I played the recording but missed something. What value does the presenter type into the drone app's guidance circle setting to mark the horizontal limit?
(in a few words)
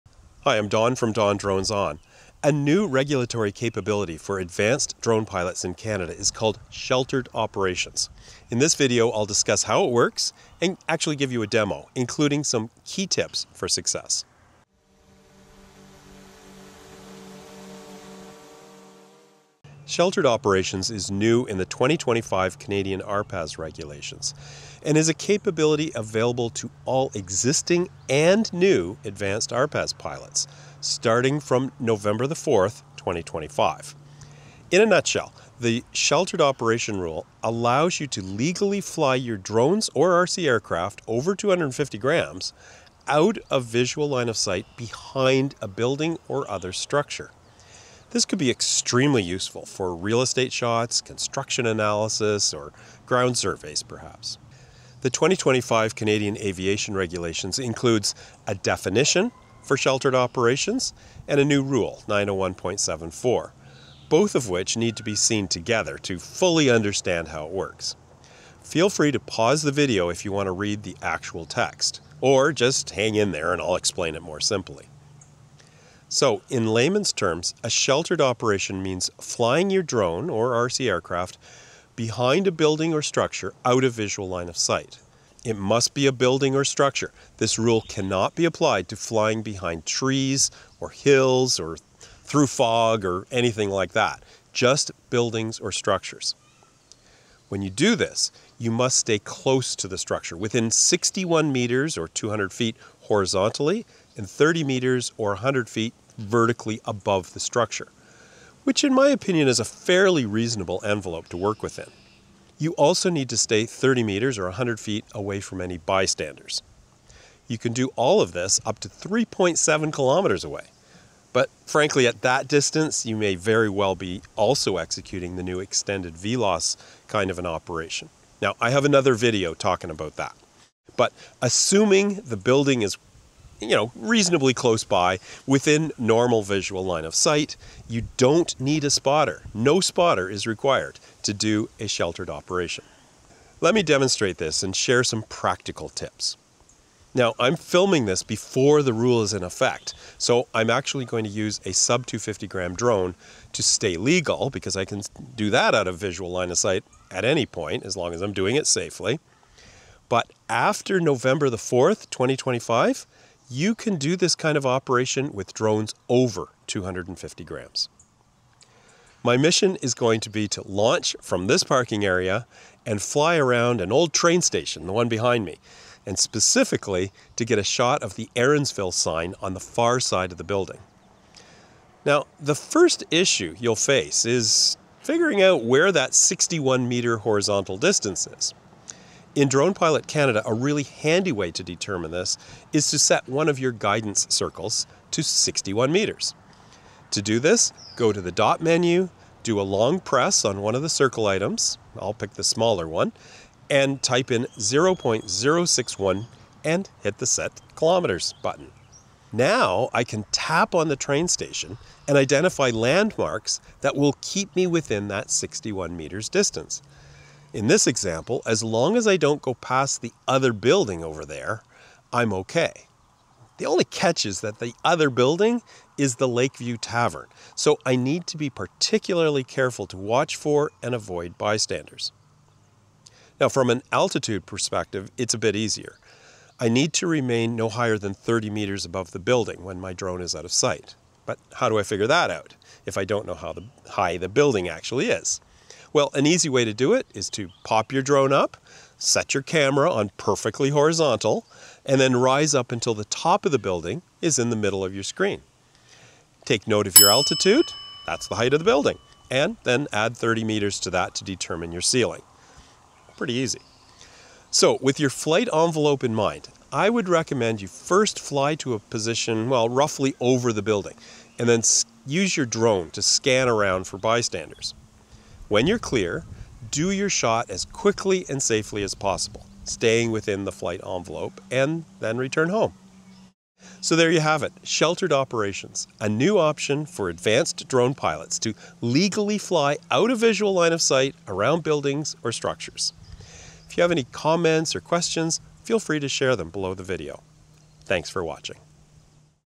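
0.061.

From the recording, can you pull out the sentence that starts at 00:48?
This could be extremely useful for real estate shots, construction analysis, or ground surveys perhaps.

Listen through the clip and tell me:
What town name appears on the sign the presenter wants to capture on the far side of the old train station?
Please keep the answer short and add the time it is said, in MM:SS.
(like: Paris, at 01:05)
Erinsville, at 02:58.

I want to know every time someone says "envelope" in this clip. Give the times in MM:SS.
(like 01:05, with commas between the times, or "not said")
01:50, 04:25, 04:40.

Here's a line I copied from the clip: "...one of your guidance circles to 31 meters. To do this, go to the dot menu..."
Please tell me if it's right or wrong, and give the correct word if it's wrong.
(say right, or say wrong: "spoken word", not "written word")
wrong: "61", not "31".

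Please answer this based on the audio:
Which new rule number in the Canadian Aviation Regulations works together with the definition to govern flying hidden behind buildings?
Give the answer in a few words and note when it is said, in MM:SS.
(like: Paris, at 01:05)
901.74, at 01:02.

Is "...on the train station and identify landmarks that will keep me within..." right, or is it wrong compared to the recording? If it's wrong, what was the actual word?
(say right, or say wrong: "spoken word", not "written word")
right.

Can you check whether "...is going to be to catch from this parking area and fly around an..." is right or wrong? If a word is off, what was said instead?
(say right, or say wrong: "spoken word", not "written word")
wrong: "launch", not "catch".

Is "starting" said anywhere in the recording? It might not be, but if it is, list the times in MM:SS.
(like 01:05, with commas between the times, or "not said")
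00:30.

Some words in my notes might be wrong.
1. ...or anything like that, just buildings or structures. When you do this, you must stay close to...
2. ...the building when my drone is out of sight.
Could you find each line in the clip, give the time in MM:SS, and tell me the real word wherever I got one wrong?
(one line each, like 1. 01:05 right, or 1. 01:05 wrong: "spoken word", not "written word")
1. 01:33 right
2. 03:59 right.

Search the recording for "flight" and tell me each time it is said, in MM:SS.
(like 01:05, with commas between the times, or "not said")
04:25, 04:40.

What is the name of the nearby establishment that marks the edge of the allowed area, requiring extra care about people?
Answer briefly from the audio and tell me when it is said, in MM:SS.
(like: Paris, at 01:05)
Lakeview Tavern, at 03:46.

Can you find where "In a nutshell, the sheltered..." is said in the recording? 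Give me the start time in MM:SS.
00:34.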